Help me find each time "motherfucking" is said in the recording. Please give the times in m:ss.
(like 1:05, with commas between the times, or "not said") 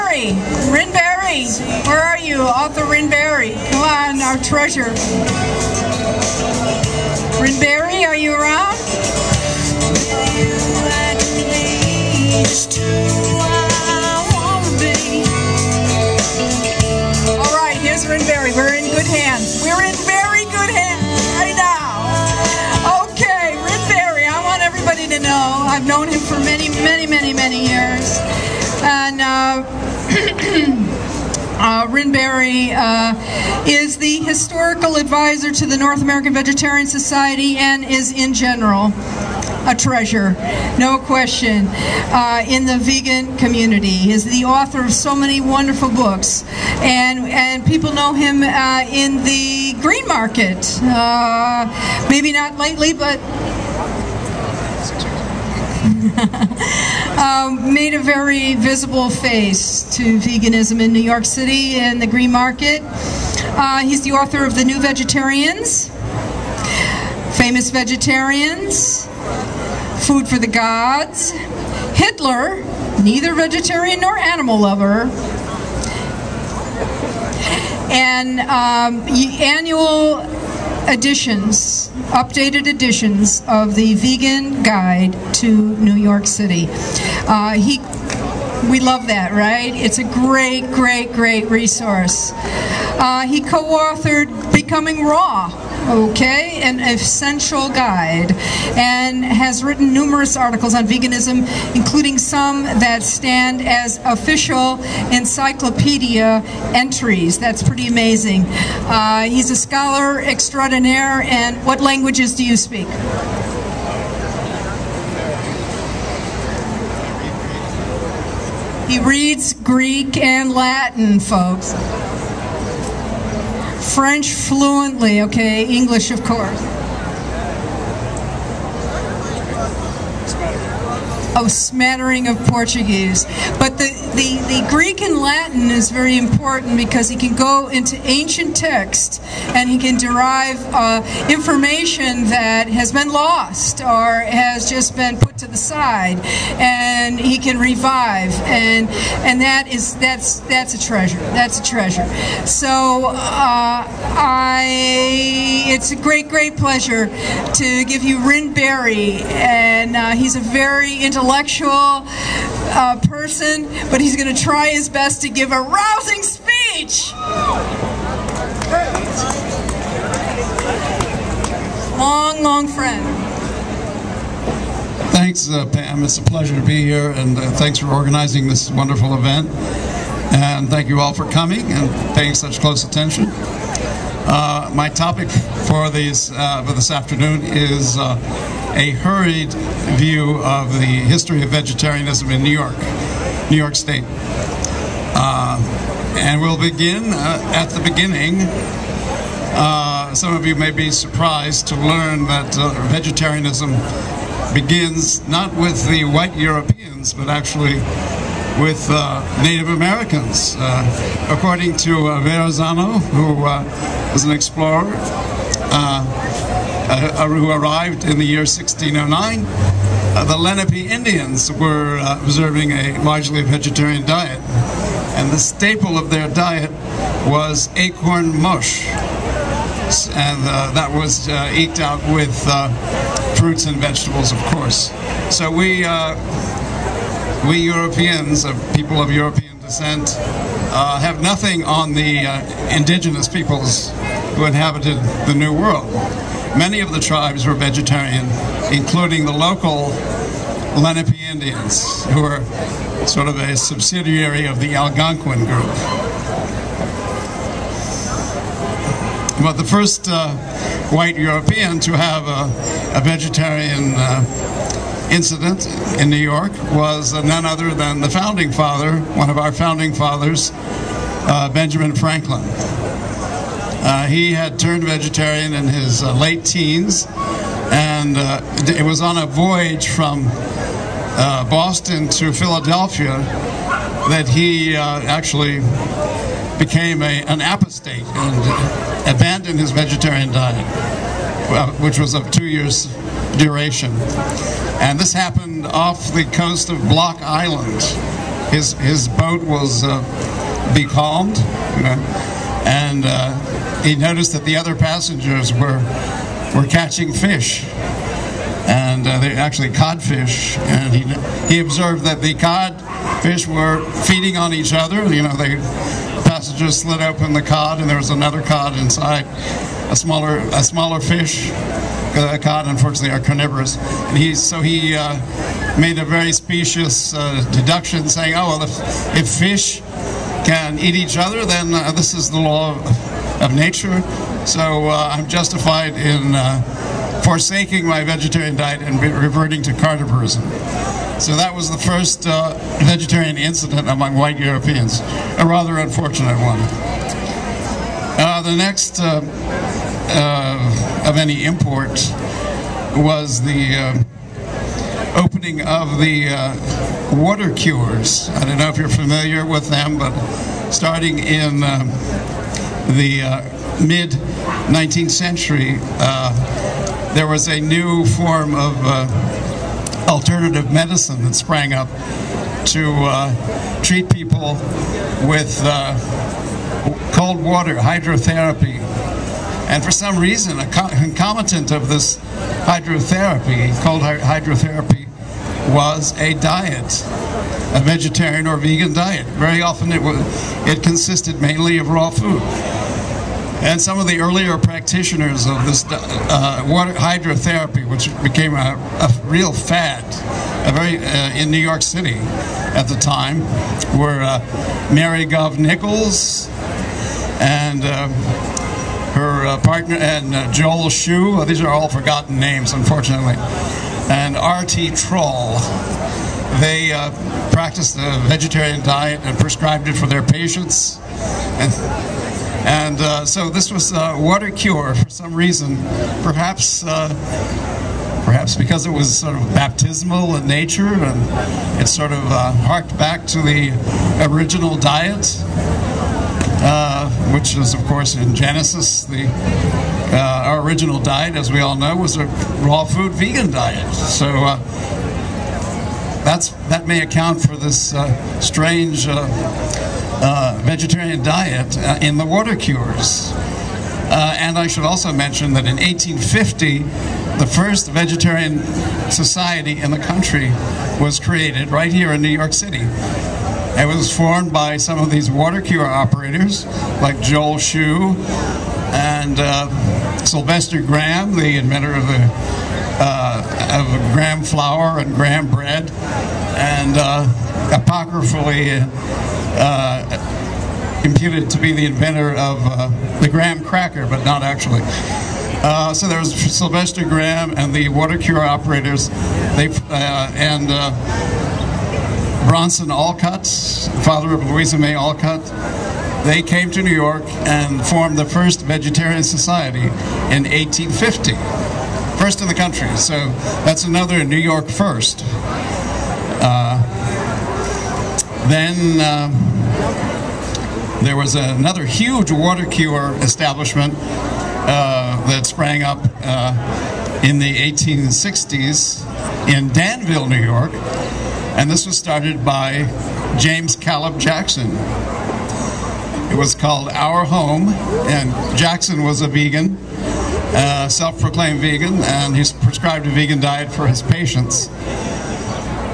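not said.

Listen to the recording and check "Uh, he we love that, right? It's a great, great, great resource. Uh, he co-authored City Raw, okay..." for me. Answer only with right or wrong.
wrong.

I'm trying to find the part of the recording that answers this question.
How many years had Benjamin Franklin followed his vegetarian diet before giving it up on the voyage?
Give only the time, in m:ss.
4:52.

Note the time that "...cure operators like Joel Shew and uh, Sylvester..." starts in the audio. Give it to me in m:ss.
7:45.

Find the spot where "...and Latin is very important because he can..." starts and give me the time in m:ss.
2:15.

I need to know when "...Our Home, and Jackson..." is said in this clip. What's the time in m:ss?
8:46.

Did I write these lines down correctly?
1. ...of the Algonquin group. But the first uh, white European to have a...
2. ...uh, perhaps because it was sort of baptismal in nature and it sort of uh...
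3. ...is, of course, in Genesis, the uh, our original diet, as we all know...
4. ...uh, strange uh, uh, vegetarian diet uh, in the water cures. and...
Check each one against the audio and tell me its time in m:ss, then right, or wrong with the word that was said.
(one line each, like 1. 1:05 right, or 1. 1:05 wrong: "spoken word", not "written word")
1. 4:14 right
2. 7:06 right
3. 7:17 right
4. 7:27 right.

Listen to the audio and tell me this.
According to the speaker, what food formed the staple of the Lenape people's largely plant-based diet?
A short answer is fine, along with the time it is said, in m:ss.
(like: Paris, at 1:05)
Acorn mush, at 3:47.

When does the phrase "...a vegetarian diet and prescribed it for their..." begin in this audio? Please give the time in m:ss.
6:57.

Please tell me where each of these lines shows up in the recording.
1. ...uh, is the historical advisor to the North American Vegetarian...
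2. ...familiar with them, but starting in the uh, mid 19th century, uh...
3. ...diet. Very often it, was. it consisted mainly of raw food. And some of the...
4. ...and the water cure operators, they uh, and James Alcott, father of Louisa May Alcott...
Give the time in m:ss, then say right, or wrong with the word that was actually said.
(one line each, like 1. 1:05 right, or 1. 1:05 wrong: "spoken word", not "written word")
1. 0:32 right
2. 5:58 right
3. 6:28 right
4. 8:07 wrong: "Bronson", not "James".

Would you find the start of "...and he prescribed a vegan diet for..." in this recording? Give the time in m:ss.
8:52.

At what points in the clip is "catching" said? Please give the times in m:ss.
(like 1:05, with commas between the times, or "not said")
5:06.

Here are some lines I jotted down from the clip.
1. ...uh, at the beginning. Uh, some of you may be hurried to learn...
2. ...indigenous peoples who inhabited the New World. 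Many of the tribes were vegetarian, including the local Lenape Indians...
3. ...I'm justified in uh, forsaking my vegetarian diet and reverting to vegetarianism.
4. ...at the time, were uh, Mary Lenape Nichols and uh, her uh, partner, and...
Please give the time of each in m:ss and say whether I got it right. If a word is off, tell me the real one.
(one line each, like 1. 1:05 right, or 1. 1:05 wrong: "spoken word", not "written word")
1. 3:17 wrong: "surprised", not "hurried"
2. 4:02 right
3. 5:35 wrong: "carnivorism", not "vegetarianism"
4. 6:42 wrong: "Gove", not "Lenape".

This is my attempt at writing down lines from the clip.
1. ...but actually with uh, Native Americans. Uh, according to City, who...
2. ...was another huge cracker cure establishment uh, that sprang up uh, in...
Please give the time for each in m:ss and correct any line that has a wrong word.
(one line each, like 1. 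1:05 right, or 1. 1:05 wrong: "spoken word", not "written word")
1. 3:27 wrong: "Verrazano", not "City"
2. 8:31 wrong: "water", not "cracker".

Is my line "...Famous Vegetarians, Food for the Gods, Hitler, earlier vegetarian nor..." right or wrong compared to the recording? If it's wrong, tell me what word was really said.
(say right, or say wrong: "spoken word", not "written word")
wrong: "neither", not "earlier".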